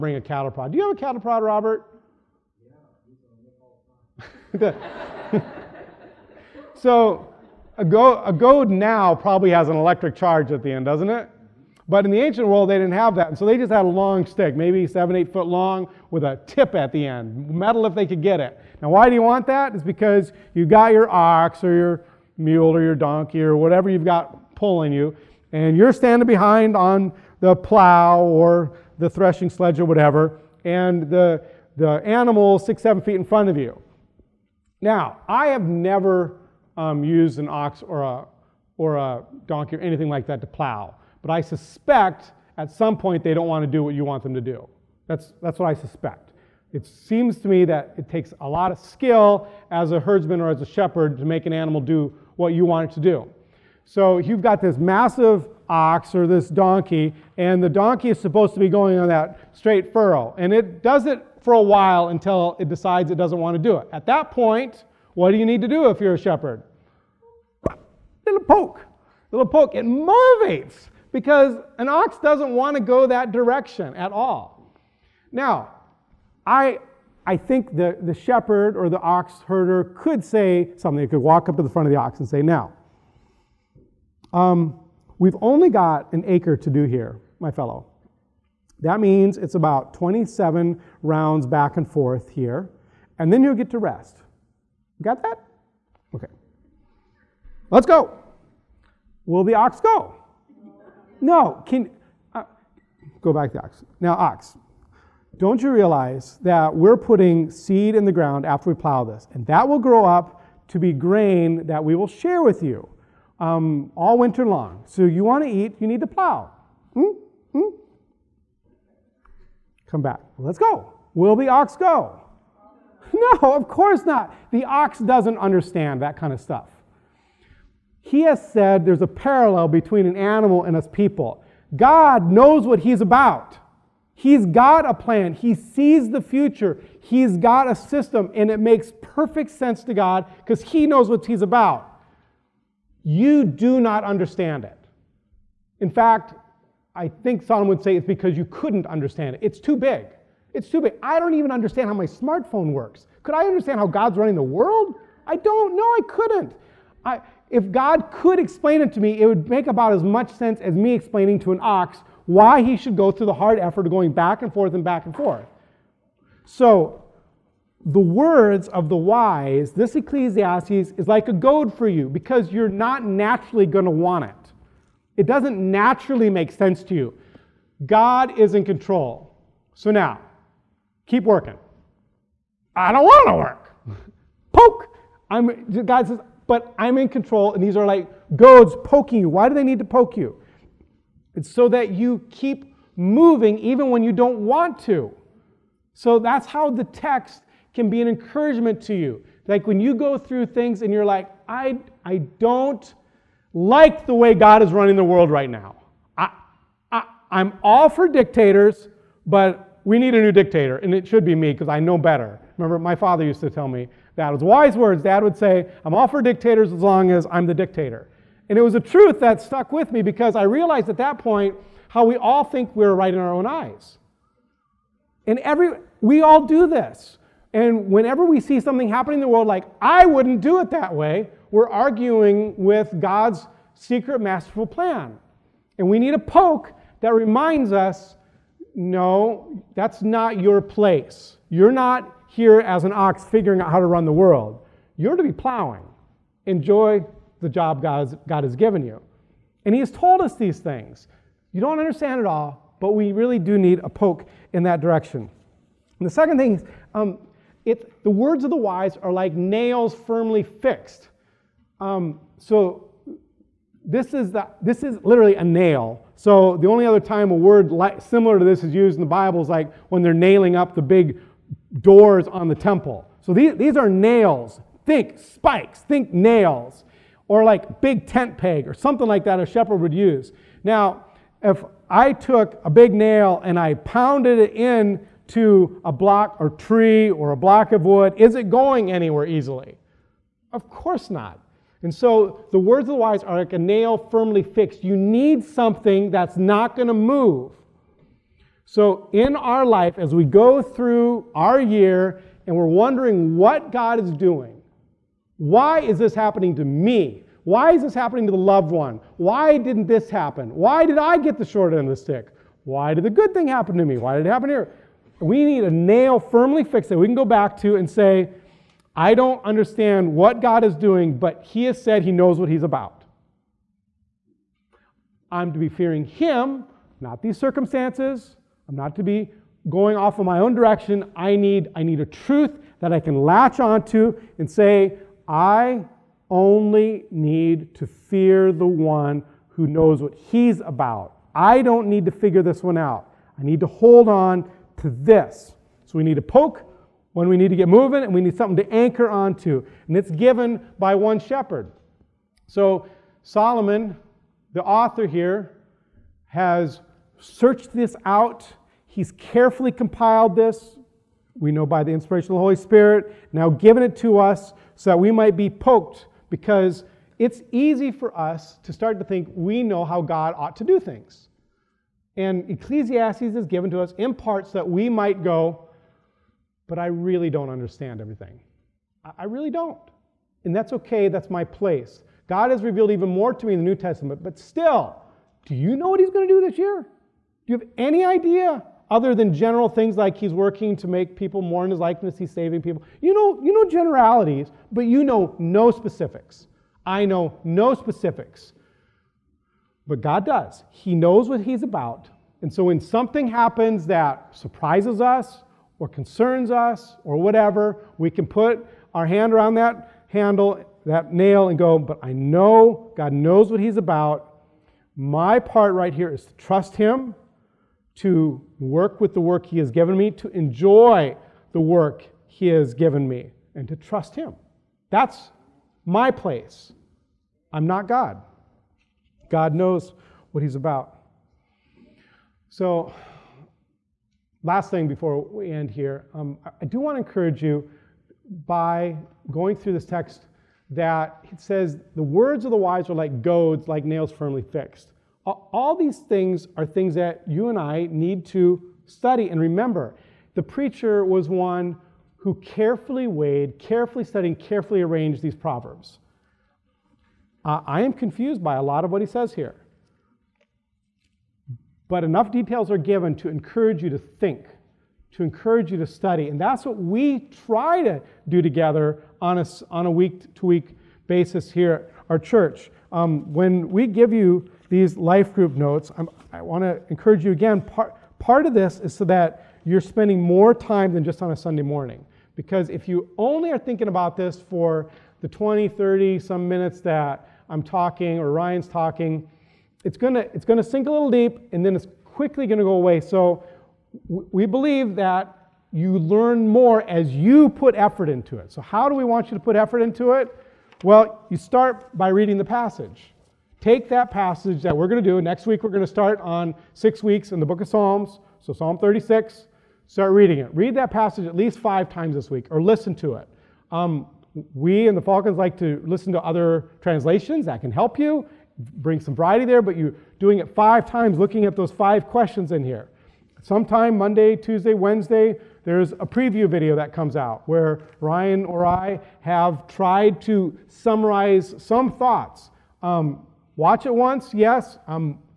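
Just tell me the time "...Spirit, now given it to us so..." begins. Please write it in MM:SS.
06:02.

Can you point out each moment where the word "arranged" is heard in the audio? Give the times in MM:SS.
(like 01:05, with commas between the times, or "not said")
07:34.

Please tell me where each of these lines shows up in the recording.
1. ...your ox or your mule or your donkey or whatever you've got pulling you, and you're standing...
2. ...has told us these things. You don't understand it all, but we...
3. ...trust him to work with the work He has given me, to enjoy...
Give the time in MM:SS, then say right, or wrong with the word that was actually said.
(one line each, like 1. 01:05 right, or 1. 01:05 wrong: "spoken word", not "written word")
1. 00:20 right
2. 04:09 right
3. 06:56 right.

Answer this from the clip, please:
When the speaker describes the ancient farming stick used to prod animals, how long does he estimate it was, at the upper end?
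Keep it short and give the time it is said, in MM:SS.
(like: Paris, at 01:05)
8 feet, at 00:15.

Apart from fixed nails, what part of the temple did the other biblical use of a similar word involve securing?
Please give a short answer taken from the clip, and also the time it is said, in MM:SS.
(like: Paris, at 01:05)
doors, at 04:31.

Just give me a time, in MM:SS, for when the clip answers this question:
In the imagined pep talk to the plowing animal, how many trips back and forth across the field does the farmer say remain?
01:29.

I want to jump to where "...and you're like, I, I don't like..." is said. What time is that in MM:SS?
03:20.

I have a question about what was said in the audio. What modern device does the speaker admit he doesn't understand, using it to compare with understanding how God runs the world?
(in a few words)
smartphone.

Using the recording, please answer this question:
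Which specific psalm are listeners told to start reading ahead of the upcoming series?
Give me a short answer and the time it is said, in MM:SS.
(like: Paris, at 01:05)
Psalm 36, at 08:28.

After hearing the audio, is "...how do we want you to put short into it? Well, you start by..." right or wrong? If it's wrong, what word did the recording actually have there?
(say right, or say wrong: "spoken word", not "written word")
wrong: "effort", not "short".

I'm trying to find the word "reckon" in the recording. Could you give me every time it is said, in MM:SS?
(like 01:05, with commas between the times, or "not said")
not said.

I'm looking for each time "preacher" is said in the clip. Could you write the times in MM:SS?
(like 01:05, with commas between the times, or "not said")
07:30.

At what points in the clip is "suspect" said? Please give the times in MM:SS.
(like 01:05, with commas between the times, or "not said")
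00:41, 00:45.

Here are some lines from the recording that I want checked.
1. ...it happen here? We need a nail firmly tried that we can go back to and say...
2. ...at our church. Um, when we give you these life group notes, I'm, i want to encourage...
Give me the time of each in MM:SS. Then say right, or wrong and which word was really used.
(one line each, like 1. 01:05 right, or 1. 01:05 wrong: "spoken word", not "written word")
1. 05:14 wrong: "fixed", not "tried"
2. 07:51 right.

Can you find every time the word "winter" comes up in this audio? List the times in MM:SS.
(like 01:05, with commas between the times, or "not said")
01:54.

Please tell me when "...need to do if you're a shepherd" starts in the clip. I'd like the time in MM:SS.
01:05.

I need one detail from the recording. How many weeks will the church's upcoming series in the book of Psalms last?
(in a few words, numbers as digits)
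6.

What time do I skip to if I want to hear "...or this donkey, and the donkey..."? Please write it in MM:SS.
00:56.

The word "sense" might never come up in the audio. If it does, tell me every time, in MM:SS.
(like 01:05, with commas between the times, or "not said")
02:19, 02:40, 02:56.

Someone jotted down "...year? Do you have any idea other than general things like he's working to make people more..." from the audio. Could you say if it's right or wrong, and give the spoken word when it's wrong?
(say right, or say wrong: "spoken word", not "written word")
right.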